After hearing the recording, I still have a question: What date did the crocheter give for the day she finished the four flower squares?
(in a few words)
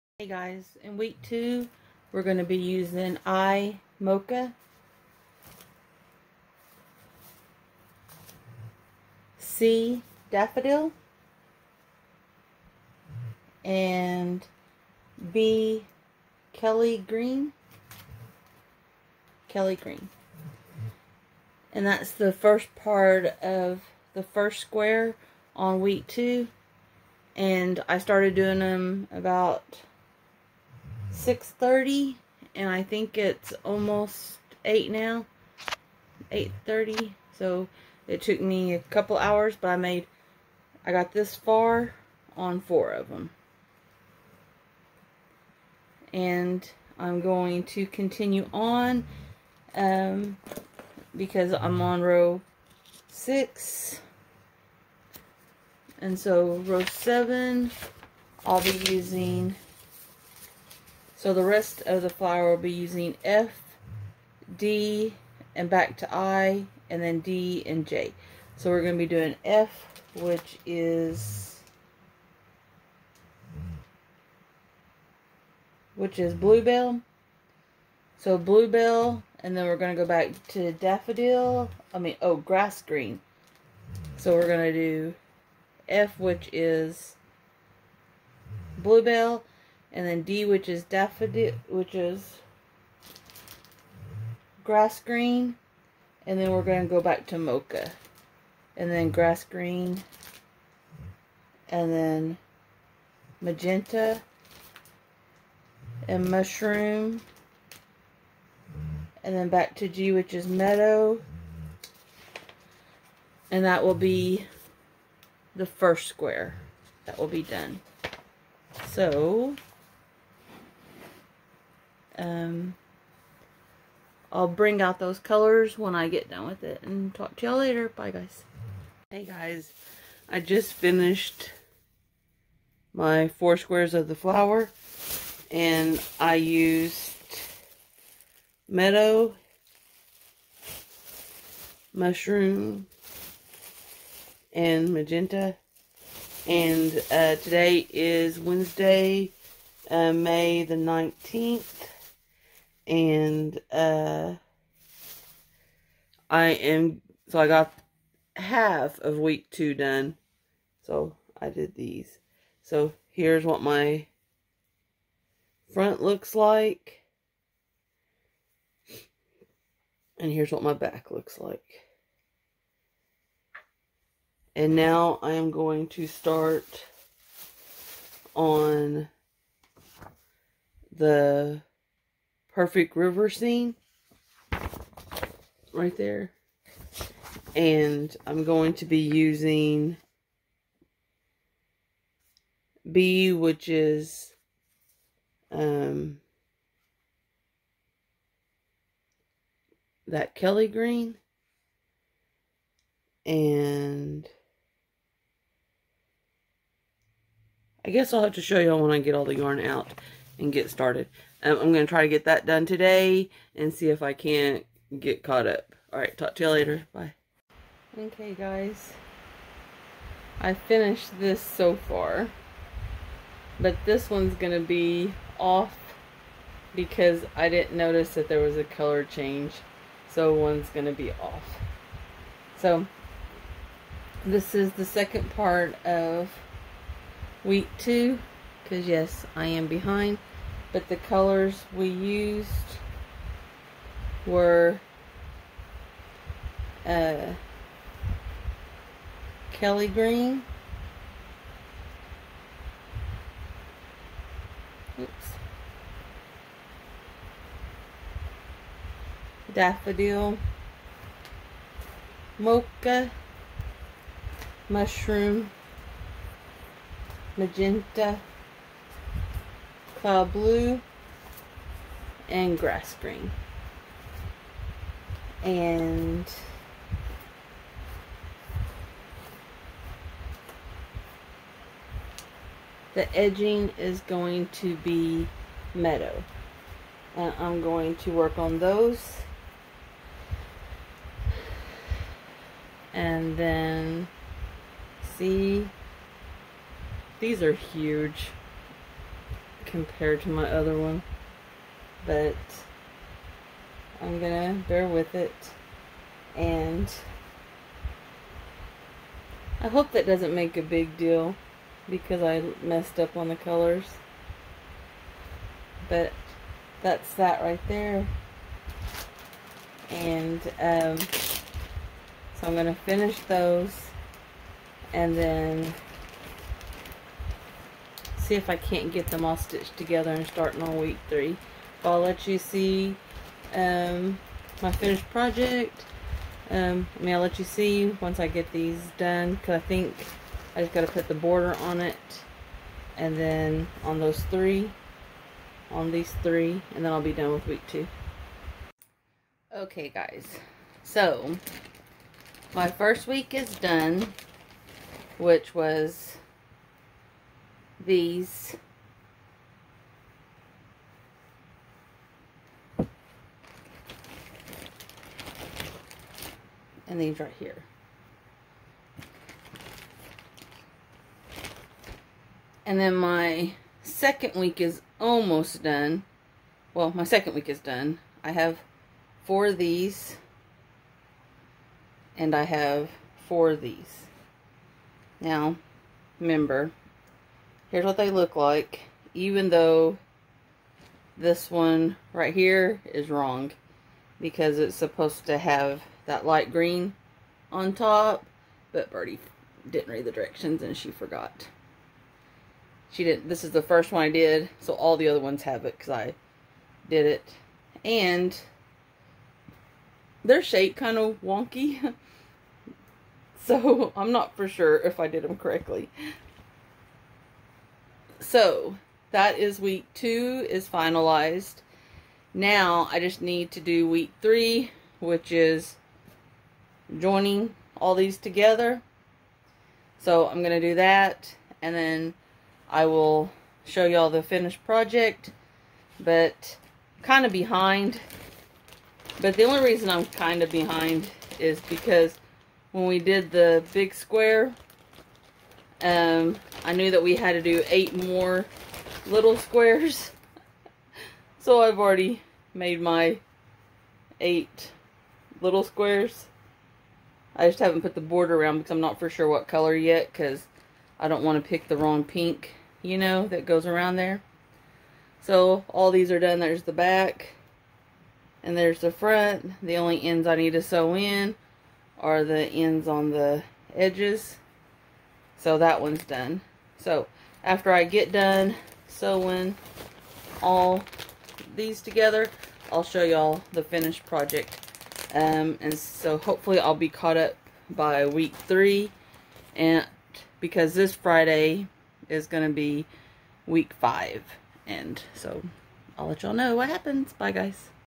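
May 19th.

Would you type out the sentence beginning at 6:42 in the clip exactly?
She did not This is the first one I did, so all the other ones have it because I did it.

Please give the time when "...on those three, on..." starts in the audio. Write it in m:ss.
5:43.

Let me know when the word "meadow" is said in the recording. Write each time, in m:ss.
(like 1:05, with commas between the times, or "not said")
1:50, 2:18, 4:45.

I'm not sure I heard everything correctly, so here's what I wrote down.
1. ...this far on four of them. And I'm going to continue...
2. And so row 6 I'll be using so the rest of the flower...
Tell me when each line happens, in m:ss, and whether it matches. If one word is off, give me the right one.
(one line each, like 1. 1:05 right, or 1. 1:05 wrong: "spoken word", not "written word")
1. 0:41 right
2. 0:55 wrong: "7", not "6".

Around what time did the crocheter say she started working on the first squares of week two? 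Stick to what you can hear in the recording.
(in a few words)
6:30.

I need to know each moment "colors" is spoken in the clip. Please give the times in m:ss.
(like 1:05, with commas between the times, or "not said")
2:05, 3:48, 4:00, 5:13, 7:39.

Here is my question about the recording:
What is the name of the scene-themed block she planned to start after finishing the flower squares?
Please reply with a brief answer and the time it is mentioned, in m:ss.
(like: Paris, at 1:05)
perfect river scene, at 3:02.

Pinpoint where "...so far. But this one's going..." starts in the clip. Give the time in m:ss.
3:41.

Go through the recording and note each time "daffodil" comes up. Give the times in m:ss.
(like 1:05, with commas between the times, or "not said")
0:10, 1:20, 1:30, 4:19.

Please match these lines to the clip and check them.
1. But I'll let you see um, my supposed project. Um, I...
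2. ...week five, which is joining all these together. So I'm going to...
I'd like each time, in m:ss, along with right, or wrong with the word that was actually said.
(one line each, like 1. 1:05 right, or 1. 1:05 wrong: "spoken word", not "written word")
1. 5:31 wrong: "finished", not "supposed"
2. 7:03 wrong: "three", not "five".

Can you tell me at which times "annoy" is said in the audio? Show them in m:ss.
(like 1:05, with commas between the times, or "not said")
not said.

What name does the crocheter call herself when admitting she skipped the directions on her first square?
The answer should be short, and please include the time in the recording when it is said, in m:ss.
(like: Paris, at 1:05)
Birdie, at 6:38.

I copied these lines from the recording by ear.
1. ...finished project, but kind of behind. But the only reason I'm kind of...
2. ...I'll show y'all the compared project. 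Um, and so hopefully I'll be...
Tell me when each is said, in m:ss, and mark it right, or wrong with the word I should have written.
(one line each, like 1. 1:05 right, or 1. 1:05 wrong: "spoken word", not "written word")
1. 7:14 right
2. 8:02 wrong: "finished", not "compared".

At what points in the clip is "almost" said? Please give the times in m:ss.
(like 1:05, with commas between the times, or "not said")
0:33, 6:14.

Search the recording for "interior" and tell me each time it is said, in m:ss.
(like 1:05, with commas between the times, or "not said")
not said.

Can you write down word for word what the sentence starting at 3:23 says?
And I guess I'll have to show y'all when I get all the yarn out and get started.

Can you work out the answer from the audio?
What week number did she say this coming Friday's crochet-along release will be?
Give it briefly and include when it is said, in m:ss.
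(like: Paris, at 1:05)
5, at 8:13.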